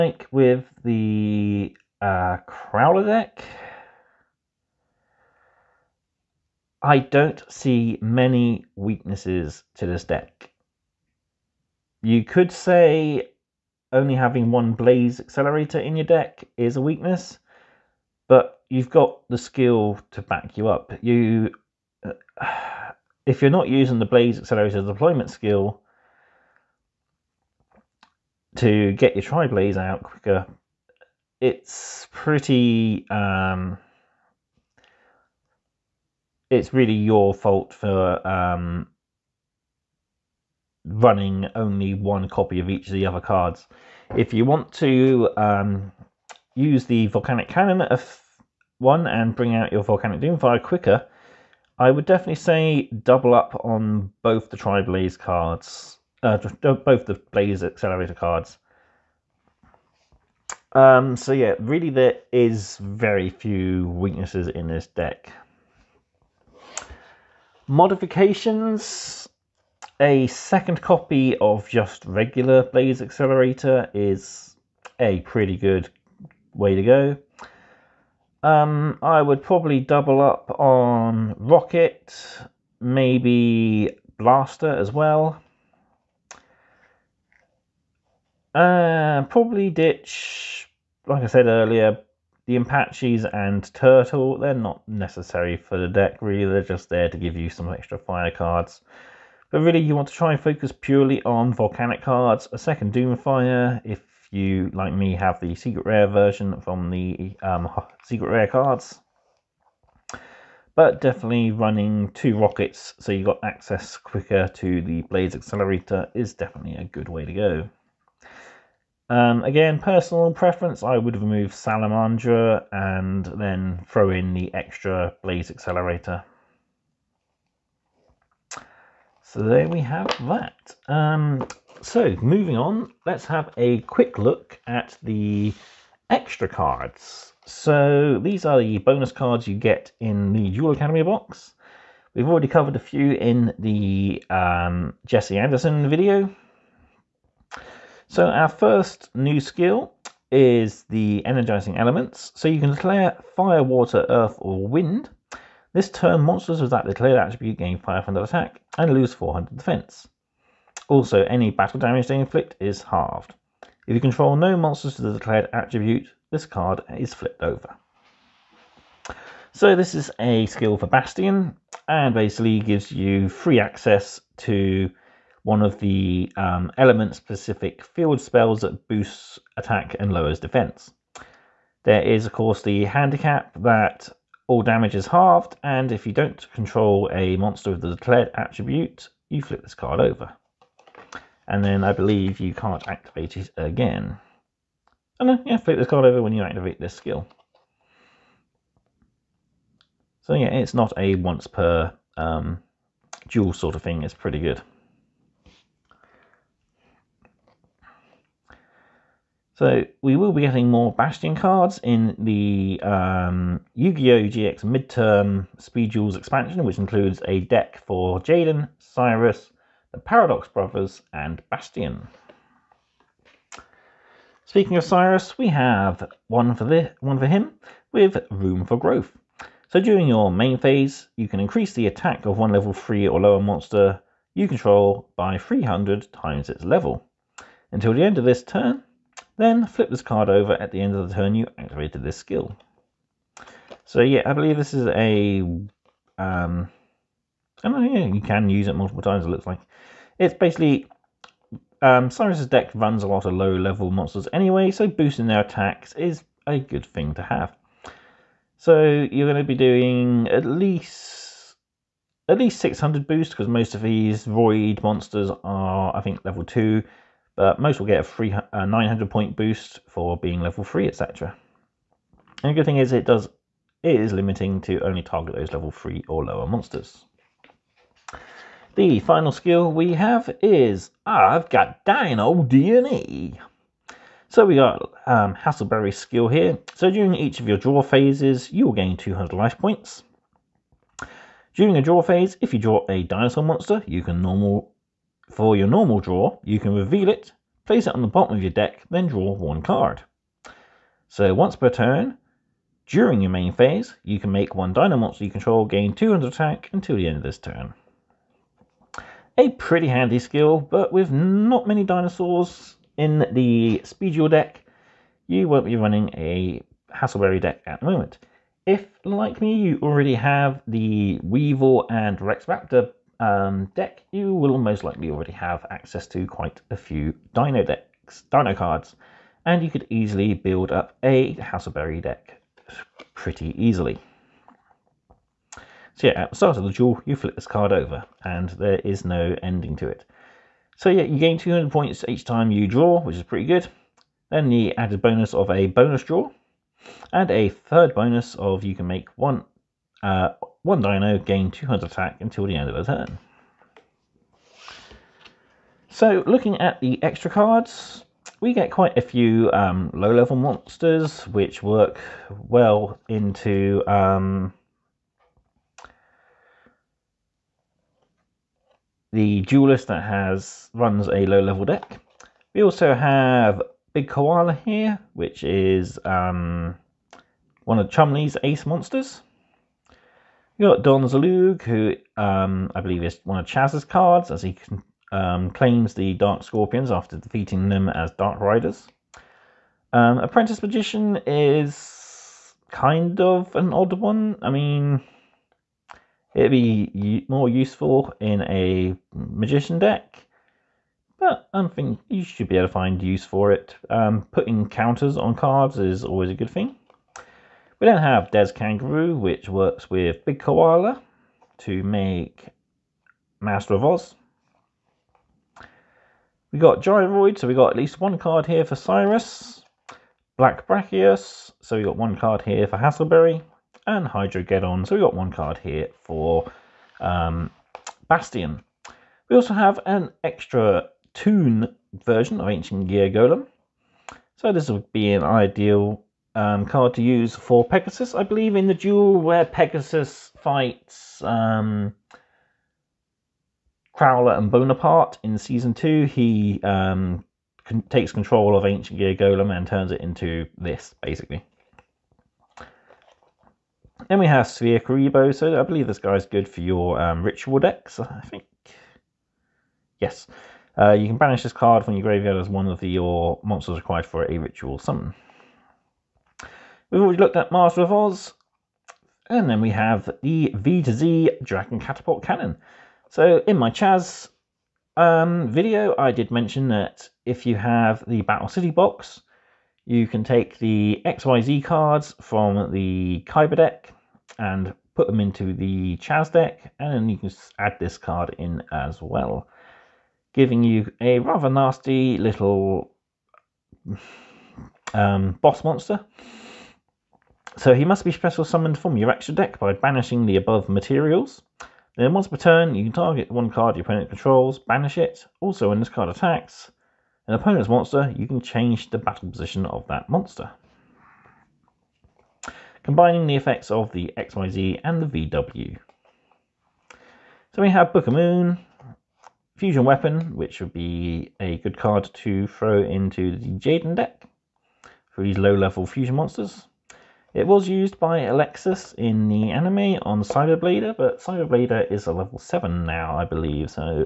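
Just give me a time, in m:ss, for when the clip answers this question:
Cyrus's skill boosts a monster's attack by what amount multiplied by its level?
3:55.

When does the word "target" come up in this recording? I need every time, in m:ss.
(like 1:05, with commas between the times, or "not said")
4:35, 8:22.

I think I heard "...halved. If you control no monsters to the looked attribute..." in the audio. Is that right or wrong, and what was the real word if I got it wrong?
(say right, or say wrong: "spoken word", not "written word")
wrong: "declared", not "looked".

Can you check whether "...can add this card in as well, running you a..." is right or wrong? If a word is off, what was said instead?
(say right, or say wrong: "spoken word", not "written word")
wrong: "giving", not "running".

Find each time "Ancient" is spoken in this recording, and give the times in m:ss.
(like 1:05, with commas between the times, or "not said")
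7:12, 7:28.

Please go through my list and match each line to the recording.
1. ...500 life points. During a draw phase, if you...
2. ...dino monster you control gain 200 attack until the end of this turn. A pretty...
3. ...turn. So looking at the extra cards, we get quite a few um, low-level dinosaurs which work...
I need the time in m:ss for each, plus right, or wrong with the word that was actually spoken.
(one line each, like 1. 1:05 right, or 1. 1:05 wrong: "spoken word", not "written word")
1. 4:48 wrong: "200", not "500"
2. 5:04 right
3. 5:52 wrong: "monsters", not "dinosaurs".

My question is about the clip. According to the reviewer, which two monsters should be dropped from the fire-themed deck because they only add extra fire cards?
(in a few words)
Apaches and Turtle.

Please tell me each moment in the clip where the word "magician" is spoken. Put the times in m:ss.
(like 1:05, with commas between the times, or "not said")
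6:30, 6:39.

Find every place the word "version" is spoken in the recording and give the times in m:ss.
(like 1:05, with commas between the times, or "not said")
1:46, 7:12.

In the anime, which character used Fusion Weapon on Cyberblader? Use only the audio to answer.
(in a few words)
Alexis.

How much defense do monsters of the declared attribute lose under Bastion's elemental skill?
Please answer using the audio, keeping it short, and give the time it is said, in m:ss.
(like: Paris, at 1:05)
400, at 2:39.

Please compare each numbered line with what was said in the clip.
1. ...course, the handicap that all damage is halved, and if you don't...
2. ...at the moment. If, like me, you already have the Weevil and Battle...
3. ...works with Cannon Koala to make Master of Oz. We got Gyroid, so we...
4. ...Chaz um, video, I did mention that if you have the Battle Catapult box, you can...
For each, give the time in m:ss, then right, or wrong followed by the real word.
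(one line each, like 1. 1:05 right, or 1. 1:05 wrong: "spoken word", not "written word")
1. 3:02 right
2. 5:17 wrong: "Rex", not "Battle"
3. 6:49 wrong: "Big", not "Cannon"
4. 7:53 wrong: "City", not "Catapult".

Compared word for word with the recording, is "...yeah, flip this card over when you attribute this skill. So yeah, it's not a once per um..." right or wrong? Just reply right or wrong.
wrong.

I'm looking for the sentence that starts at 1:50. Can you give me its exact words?
But definitely running two rockets so you got access quicker to the blaze Accelerator is definitely a good way to go.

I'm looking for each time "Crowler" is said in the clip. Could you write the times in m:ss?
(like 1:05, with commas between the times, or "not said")
0:02, 7:23.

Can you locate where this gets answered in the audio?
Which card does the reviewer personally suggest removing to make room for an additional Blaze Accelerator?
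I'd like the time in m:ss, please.
2:01.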